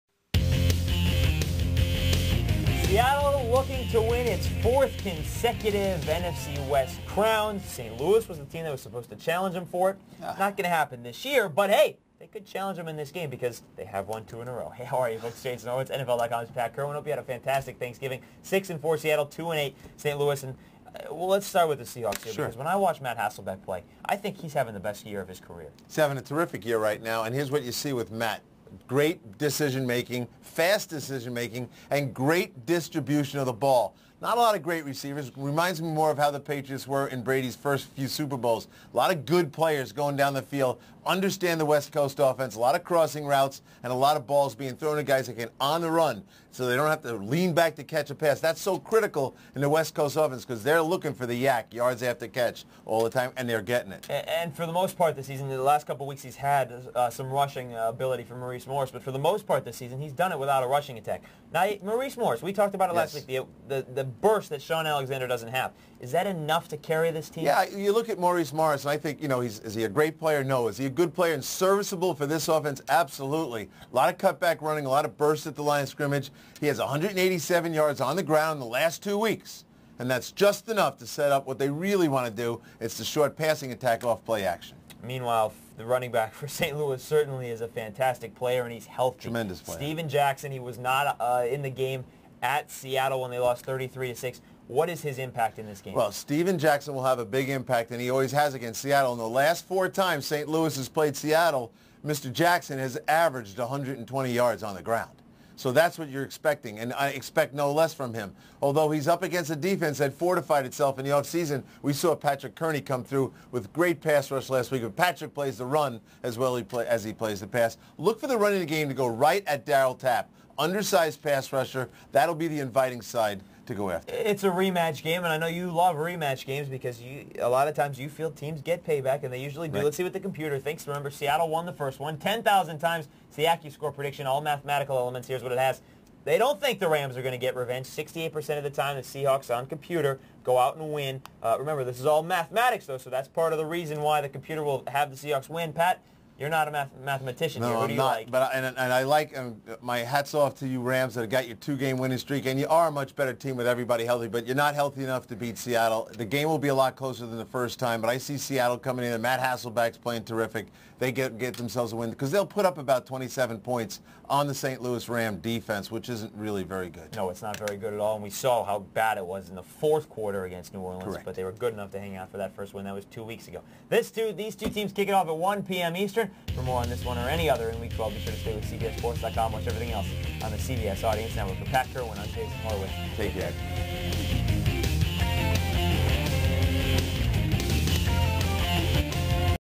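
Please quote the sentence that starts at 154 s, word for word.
But you're not healthy enough to beat Seattle.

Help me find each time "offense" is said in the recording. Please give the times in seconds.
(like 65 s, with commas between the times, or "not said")
42 s, 50 s, 72 s.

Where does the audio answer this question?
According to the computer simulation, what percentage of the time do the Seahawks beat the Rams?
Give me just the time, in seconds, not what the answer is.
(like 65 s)
137 s.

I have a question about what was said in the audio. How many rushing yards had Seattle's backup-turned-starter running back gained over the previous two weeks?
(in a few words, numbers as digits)
187.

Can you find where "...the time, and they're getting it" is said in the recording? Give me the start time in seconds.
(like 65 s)
53 s.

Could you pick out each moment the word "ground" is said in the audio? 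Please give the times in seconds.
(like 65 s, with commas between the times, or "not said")
78 s, 104 s.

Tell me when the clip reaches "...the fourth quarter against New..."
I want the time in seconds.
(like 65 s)
169 s.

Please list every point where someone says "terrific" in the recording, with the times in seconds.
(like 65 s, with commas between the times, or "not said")
26 s, 160 s.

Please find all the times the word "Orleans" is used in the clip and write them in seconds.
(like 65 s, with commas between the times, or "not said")
170 s.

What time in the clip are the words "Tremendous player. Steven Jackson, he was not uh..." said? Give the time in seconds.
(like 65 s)
89 s.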